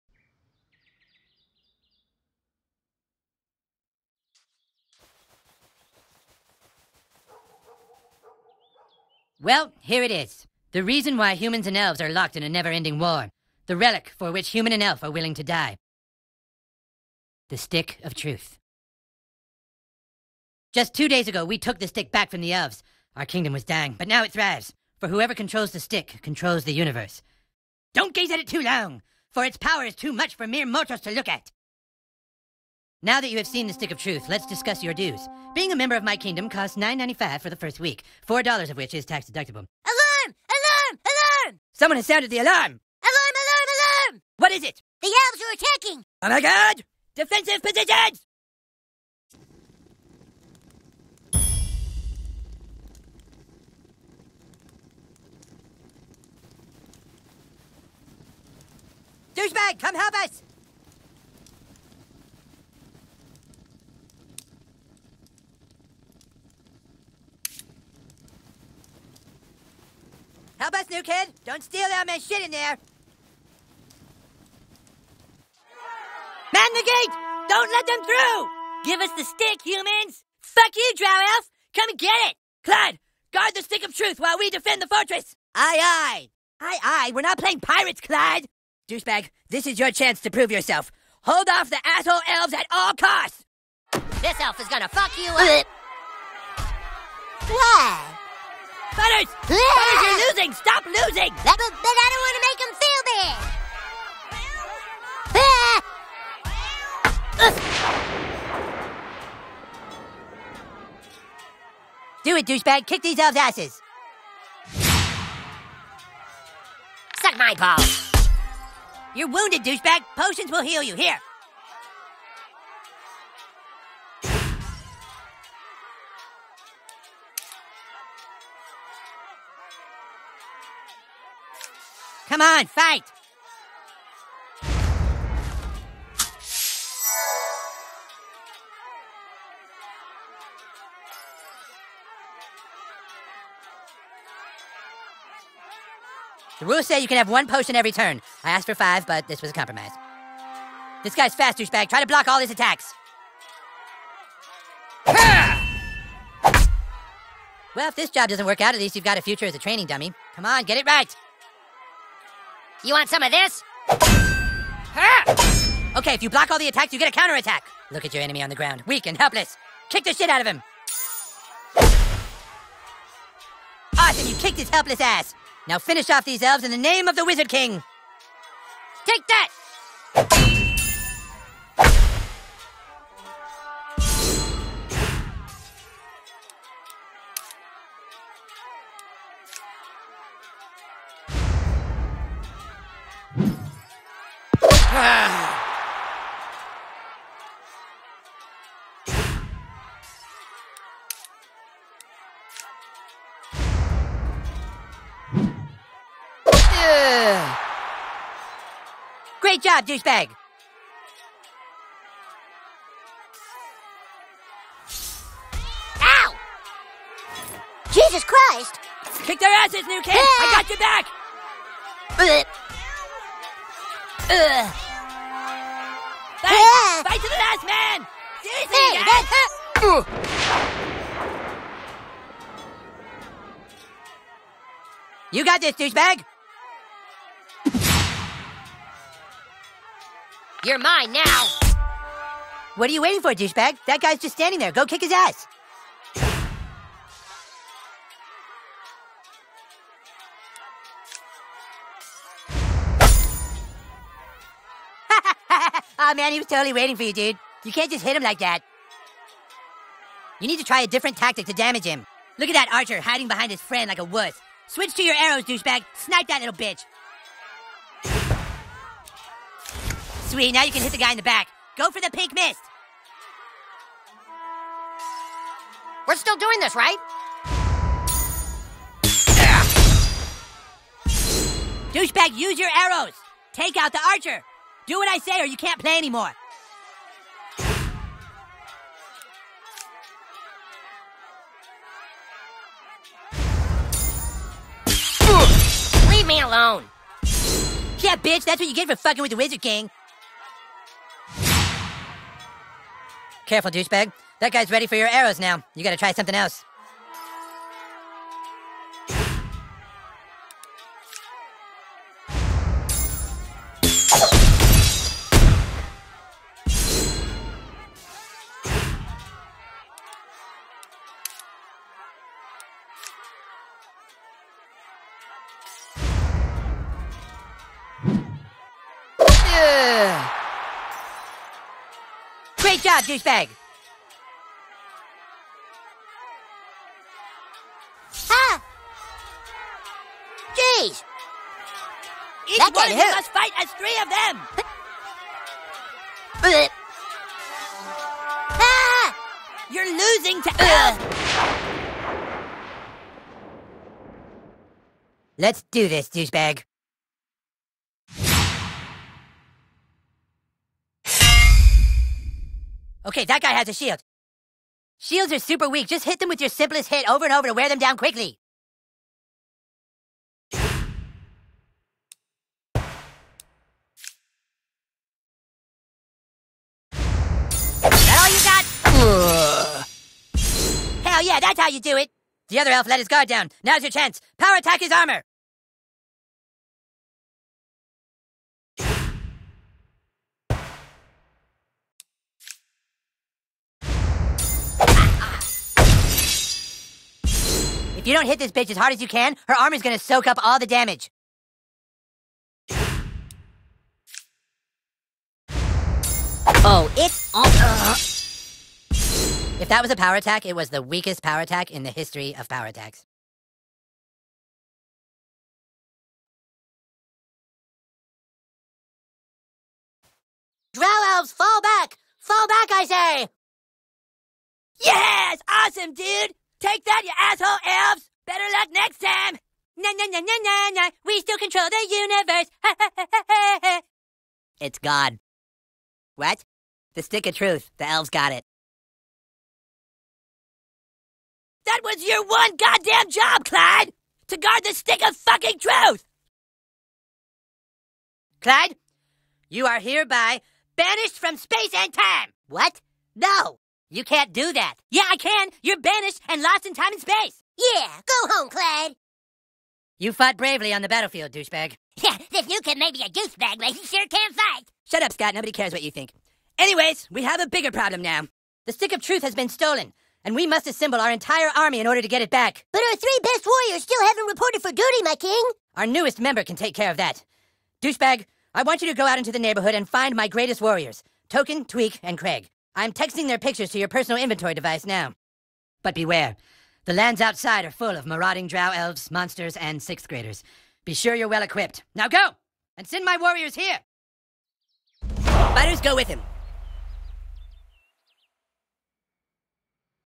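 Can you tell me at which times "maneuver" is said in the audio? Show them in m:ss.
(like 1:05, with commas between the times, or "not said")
not said.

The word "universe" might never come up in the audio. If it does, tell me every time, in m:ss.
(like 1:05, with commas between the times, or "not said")
0:26, 7:11.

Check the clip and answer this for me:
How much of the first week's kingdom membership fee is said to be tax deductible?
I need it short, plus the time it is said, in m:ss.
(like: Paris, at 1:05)
$4, at 0:38.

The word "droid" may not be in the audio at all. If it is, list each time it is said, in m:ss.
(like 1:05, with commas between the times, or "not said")
not said.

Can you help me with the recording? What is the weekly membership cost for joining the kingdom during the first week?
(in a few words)
$9.95.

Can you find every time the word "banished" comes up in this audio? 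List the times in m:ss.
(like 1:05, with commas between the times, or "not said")
7:30, 7:35.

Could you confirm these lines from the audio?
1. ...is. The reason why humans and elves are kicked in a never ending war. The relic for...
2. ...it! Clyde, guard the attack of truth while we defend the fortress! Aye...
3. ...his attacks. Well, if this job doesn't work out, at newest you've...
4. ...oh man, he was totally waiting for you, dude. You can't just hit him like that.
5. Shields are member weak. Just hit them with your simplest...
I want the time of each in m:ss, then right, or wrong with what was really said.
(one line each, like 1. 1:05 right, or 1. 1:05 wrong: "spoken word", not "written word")
1. 0:10 wrong: "locked", not "kicked"
2. 1:22 wrong: "stick", not "attack"
3. 2:32 wrong: "least", not "newest"
4. 4:15 right
5. 6:04 wrong: "super", not "member".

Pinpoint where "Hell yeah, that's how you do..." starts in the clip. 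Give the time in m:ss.
6:21.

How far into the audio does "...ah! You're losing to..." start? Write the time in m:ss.
5:48.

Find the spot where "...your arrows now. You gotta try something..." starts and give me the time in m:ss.
5:04.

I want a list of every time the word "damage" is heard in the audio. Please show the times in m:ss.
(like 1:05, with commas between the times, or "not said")
4:21, 6:40.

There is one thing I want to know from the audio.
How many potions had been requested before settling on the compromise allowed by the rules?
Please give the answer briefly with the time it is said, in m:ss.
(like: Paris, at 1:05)
5, at 2:28.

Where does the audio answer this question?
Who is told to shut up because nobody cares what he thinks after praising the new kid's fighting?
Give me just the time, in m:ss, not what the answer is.
7:45.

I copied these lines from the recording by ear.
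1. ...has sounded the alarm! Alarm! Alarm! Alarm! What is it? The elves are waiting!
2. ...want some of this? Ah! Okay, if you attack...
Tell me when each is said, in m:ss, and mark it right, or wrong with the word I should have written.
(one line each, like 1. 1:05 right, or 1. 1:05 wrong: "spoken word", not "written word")
1. 0:41 wrong: "attacking", not "waiting"
2. 2:42 wrong: "block", not "attack".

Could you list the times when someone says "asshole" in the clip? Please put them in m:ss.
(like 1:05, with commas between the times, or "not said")
1:31, 7:07.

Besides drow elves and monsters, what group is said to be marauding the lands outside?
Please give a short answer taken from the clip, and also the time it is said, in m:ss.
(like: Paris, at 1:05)
sixth graders, at 8:09.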